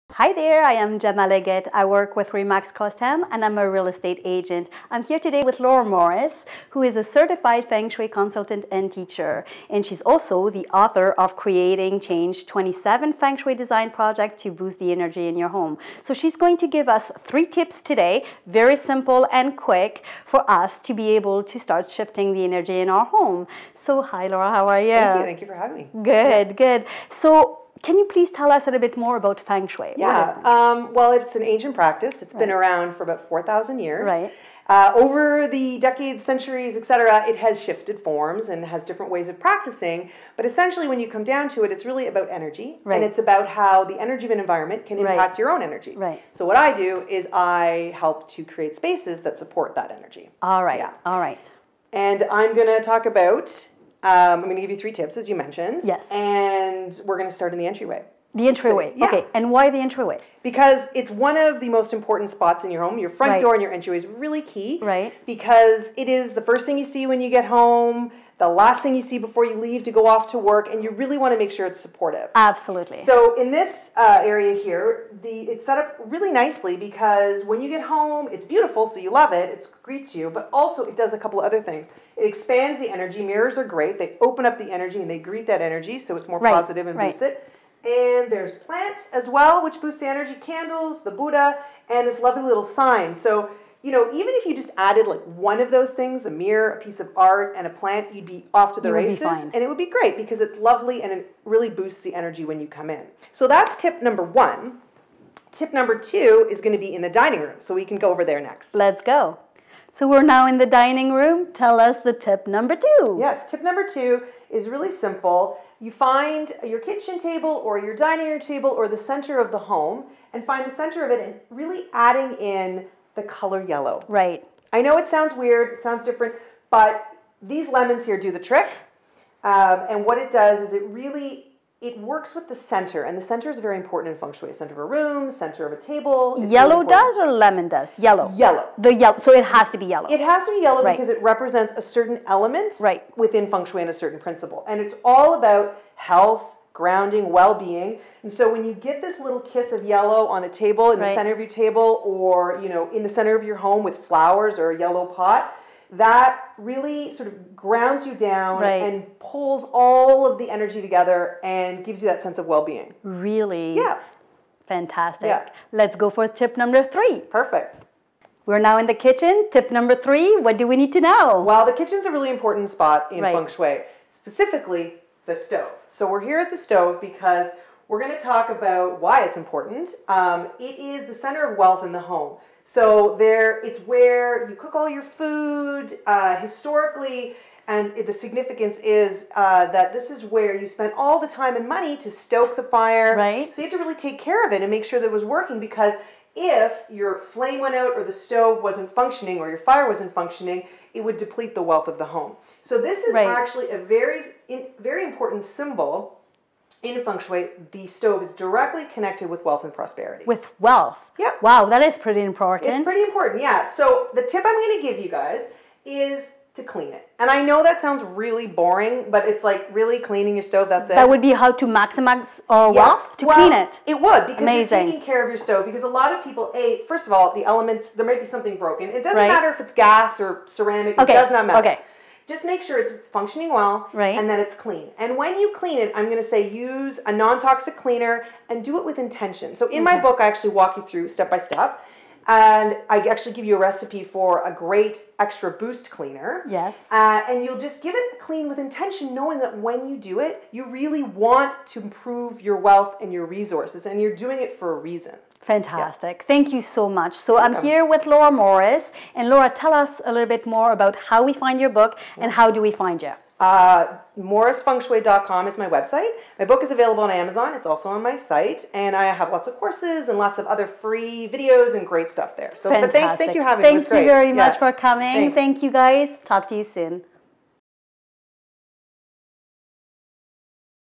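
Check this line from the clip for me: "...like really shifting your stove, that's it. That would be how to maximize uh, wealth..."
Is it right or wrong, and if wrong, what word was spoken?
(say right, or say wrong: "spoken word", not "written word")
wrong: "cleaning", not "shifting".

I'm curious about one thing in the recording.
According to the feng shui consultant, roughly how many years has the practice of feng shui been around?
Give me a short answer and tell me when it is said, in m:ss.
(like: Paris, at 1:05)
4,000 years, at 0:33.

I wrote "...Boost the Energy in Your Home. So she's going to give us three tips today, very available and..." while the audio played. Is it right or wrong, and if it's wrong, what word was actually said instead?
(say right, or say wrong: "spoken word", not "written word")
wrong: "simple", not "available".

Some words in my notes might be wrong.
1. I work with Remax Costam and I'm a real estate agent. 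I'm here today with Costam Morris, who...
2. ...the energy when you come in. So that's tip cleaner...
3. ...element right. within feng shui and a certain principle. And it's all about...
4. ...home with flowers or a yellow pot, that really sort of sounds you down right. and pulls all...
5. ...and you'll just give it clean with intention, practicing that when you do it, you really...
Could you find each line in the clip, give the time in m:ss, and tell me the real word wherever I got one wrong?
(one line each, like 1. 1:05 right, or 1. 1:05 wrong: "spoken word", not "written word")
1. 0:01 wrong: "Laura", not "Costam"
2. 1:42 wrong: "number", not "cleaner"
3. 2:22 right
4. 2:33 wrong: "grounds", not "sounds"
5. 4:07 wrong: "knowing", not "practicing".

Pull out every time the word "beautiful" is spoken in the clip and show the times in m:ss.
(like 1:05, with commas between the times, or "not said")
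1:18.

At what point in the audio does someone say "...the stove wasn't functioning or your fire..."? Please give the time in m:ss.
3:18.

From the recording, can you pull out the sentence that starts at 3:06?
Uh, historically, and the significance is uh, that this is where you spent all the time and money to stoke the fire.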